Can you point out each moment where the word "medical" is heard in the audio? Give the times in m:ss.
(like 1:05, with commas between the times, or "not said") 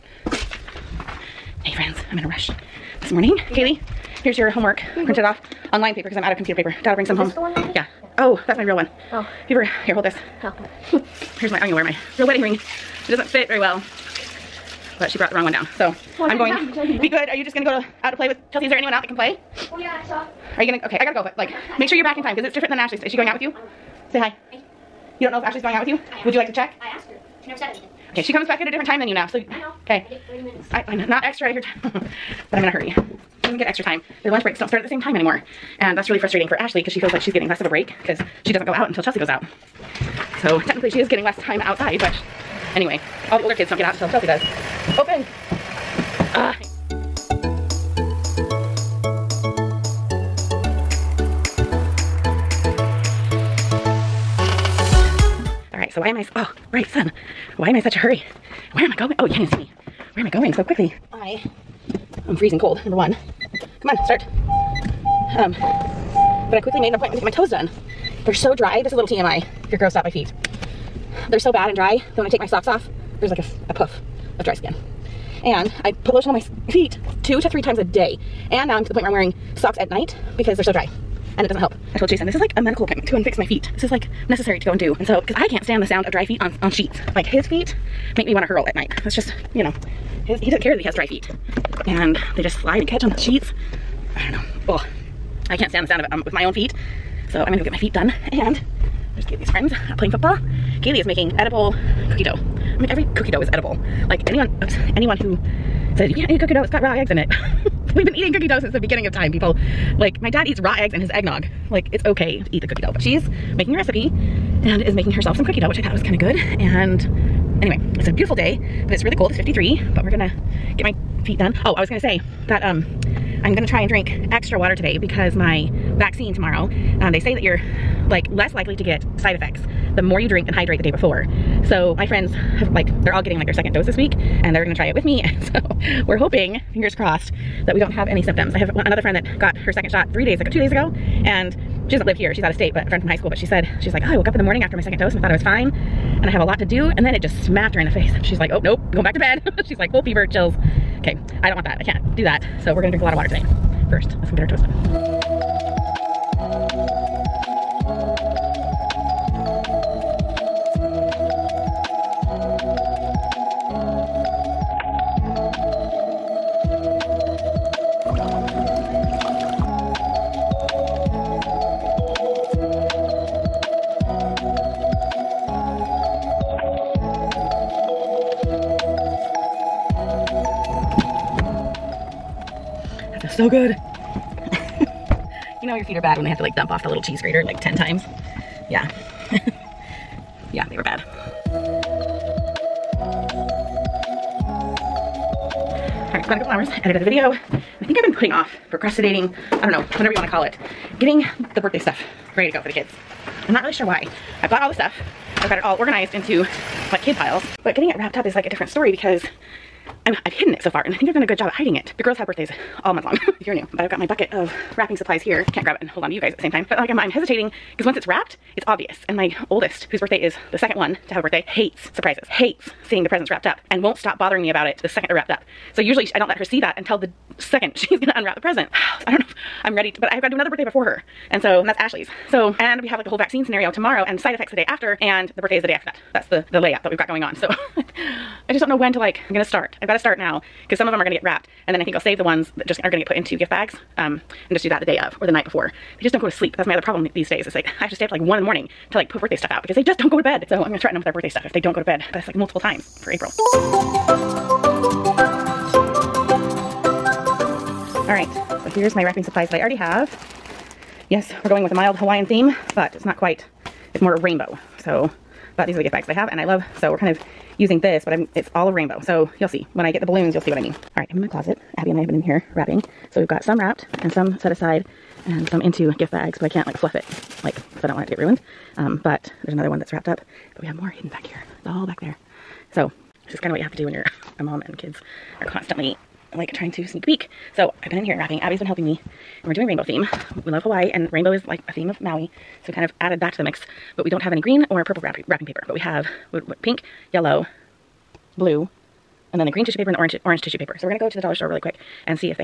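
1:22.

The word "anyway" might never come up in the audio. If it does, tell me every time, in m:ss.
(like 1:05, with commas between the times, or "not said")
0:42, 1:57.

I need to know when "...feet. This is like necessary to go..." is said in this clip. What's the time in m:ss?
1:23.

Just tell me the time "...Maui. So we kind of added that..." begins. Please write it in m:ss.
4:52.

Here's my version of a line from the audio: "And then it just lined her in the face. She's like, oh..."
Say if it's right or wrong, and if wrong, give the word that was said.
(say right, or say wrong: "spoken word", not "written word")
wrong: "smacked", not "lined".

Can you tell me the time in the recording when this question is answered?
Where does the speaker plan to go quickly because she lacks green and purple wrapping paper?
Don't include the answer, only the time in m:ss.
5:01.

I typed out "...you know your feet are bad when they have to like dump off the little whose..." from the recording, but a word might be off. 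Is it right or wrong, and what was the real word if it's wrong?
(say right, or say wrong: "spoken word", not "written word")
wrong: "cheese", not "whose".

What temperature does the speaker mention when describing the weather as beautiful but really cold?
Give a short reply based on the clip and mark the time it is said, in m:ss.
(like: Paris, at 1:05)
53, at 1:59.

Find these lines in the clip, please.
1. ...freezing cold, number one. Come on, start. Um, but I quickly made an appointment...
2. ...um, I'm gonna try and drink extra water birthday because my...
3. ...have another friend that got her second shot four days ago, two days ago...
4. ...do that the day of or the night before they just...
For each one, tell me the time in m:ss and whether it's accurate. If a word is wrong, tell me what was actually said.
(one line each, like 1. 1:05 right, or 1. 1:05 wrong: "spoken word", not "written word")
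1. 1:02 right
2. 2:02 wrong: "today", not "birthday"
3. 2:18 wrong: "three", not "four"
4. 4:04 right.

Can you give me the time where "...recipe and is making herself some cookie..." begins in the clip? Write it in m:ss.
1:53.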